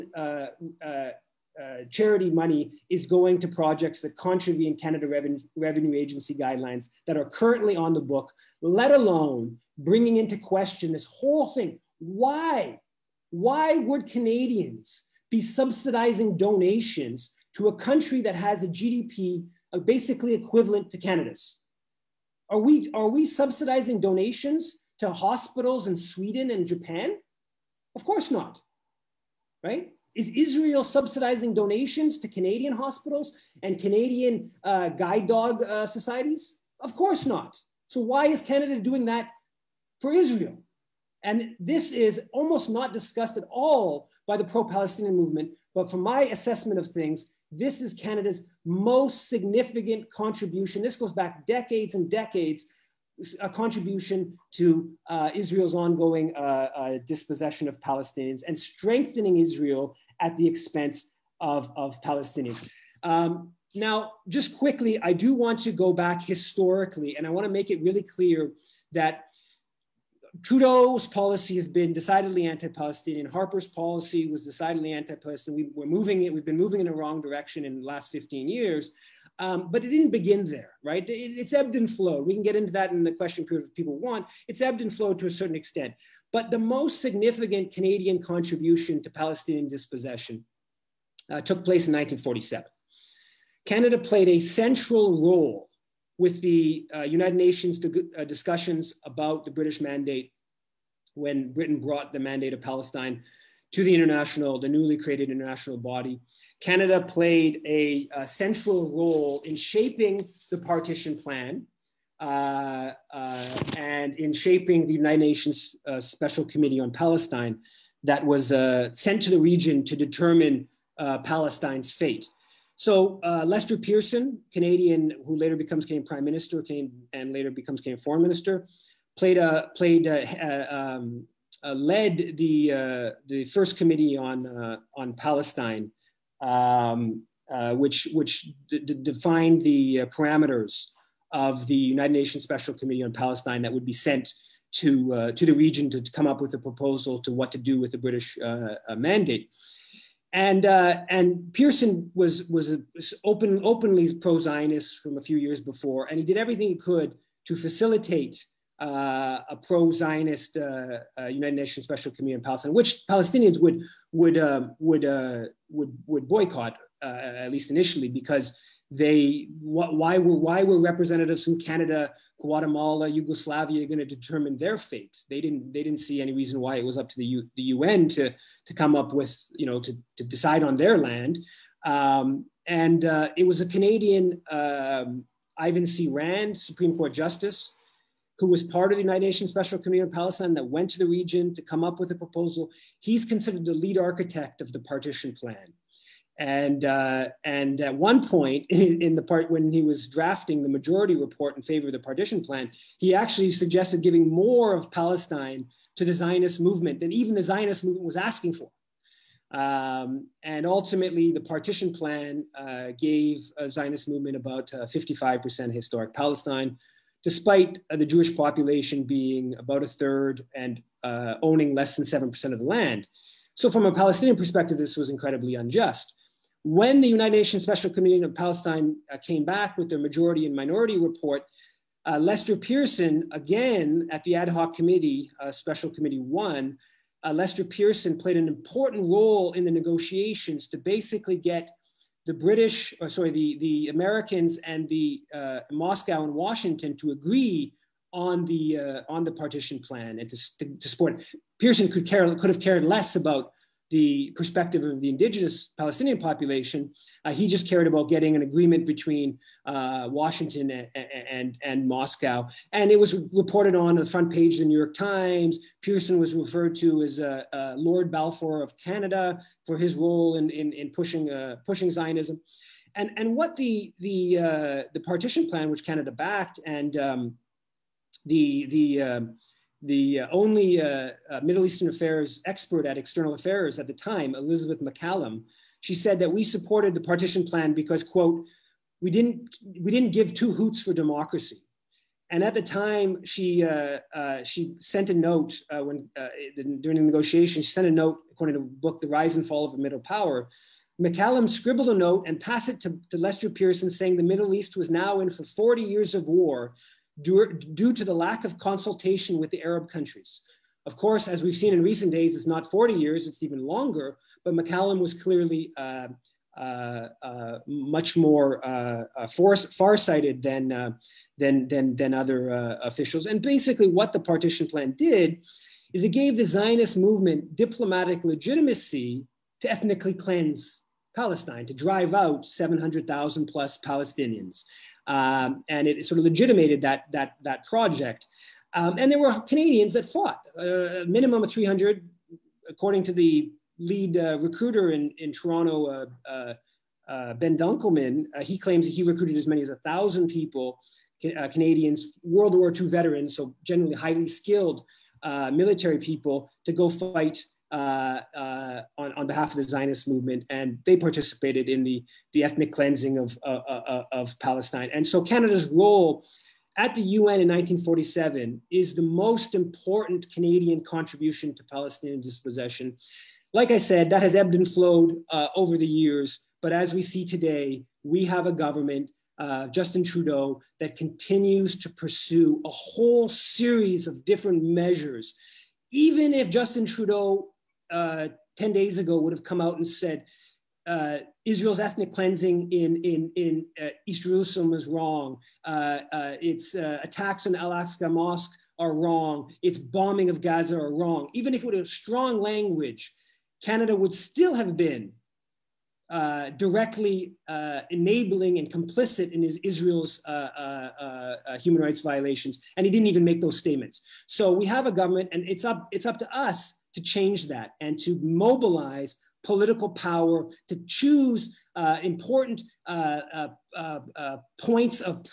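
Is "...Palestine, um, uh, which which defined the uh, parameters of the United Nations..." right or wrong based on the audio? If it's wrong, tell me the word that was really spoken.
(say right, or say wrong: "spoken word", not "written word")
right.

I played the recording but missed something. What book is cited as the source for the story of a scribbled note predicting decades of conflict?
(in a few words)
The Rise and Fall of a Middle Power.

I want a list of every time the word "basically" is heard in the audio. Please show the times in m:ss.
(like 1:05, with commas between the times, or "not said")
0:19, 4:00, 5:23.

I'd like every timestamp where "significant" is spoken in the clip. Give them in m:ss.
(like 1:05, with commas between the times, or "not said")
0:49, 1:27.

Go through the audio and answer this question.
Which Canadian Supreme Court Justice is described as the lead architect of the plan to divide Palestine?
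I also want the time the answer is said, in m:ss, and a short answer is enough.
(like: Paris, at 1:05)
Ivan C. Rand, at 3:05.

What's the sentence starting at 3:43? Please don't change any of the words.
So, from a Palestinian perspective, this was incredibly unjust.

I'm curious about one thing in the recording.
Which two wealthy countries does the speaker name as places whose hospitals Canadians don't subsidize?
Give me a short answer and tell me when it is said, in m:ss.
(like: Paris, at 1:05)
Sweden and Japan, at 0:25.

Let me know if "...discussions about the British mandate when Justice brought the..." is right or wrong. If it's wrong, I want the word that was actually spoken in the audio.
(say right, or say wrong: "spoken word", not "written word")
wrong: "Britain", not "Justice".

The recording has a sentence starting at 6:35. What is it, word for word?
Uh, uh, its uh, attacks on Al Aqsa Mosque are wrong.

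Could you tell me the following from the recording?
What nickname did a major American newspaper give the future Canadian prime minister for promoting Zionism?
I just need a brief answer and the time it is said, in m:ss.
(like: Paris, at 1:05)
Lord Balfour of Canada, at 4:27.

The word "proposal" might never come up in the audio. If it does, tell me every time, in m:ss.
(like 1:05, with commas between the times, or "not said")
2:26, 3:12.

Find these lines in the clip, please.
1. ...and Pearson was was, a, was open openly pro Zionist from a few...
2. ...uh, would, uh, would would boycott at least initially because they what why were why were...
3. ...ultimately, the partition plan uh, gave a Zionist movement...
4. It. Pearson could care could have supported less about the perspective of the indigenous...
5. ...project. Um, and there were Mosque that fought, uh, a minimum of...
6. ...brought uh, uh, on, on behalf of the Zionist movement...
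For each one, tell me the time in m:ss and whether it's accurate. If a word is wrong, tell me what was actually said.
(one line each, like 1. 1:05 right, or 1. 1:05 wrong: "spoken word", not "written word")
1. 2:31 right
2. 2:44 right
3. 3:30 right
4. 4:11 wrong: "cared", not "supported"
5. 5:37 wrong: "Canadians", not "Mosque"
6. 5:56 wrong: "fight", not "brought".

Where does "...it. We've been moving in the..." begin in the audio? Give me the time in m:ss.
1:16.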